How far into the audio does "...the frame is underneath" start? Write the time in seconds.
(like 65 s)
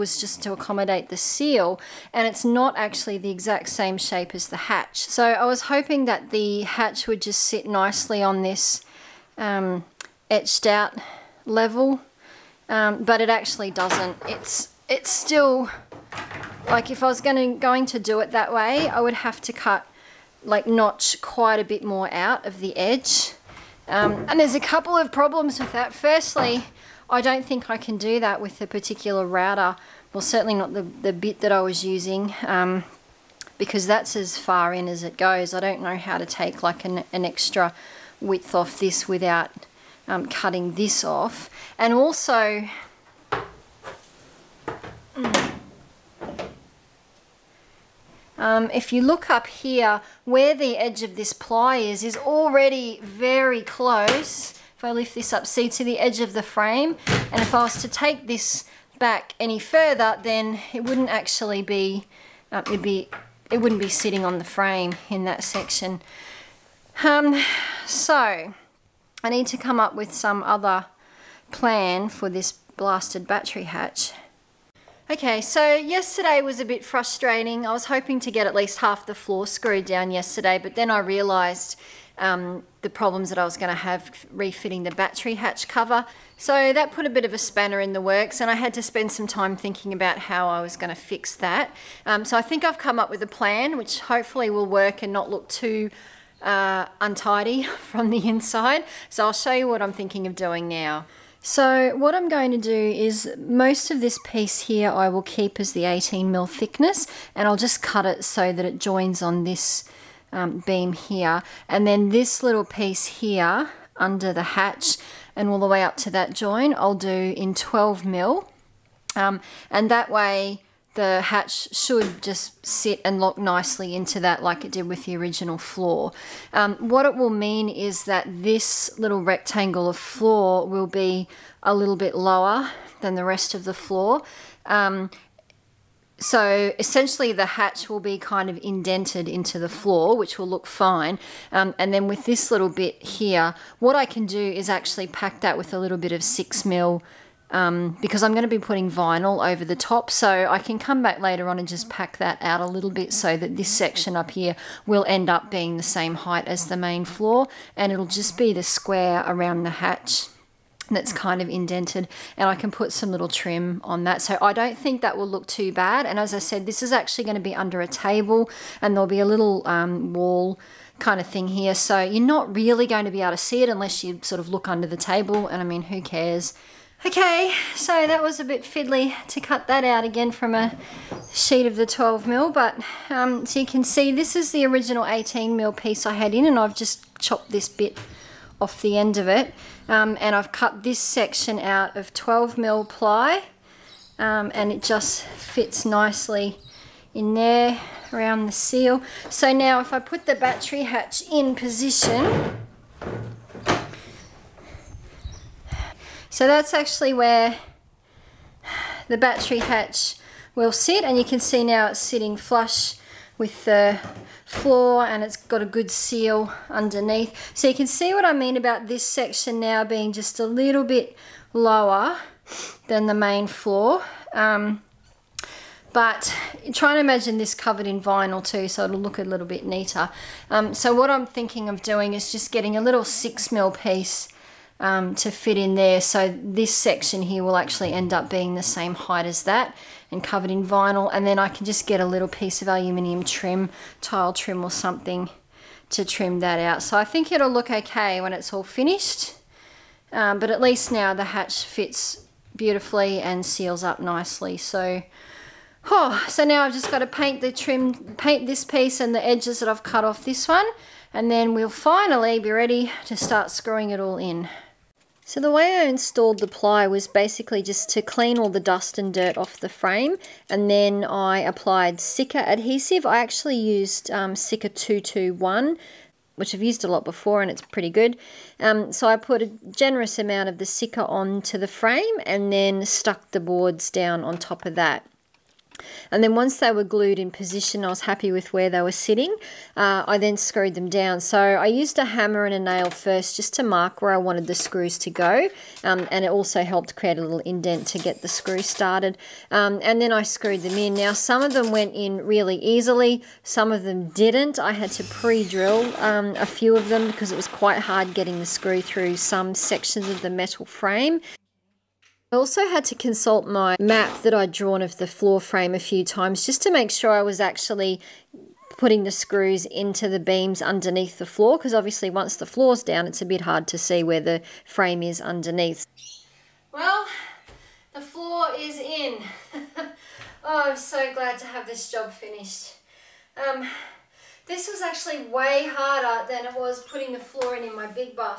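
324 s.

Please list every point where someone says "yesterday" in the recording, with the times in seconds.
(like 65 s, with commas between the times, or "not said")
75 s, 80 s.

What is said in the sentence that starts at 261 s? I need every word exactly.
And then we'll finally be ready to start screwing it all in.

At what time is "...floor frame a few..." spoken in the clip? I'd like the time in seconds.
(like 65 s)
315 s.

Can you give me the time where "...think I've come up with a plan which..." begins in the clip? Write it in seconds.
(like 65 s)
92 s.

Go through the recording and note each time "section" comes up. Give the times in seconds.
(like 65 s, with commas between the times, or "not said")
65 s, 153 s, 190 s, 219 s, 236 s, 309 s.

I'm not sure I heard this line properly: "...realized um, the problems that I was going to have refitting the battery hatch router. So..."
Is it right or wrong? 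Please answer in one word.
wrong.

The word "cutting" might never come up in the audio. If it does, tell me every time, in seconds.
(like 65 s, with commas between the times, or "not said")
40 s.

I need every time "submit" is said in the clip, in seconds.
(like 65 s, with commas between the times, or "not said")
not said.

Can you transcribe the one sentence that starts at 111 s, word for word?
And then this little piece here under the hatch and all the way up to that join, I'll do in 12 mil.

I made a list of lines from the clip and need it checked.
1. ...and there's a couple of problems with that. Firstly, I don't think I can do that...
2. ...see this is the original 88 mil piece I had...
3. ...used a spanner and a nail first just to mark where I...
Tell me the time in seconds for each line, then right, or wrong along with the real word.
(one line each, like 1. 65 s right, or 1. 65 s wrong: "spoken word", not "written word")
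1. 24 s right
2. 183 s wrong: "18", not "88"
3. 291 s wrong: "hammer", not "spanner".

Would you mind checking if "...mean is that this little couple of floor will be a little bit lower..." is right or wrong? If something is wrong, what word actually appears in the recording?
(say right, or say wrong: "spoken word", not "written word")
wrong: "rectangle", not "couple".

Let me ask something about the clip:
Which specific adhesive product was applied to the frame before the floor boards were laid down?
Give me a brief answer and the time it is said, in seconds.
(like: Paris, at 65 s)
Sika 221, at 274 s.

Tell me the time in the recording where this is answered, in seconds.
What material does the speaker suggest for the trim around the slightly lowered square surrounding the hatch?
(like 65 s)
242 s.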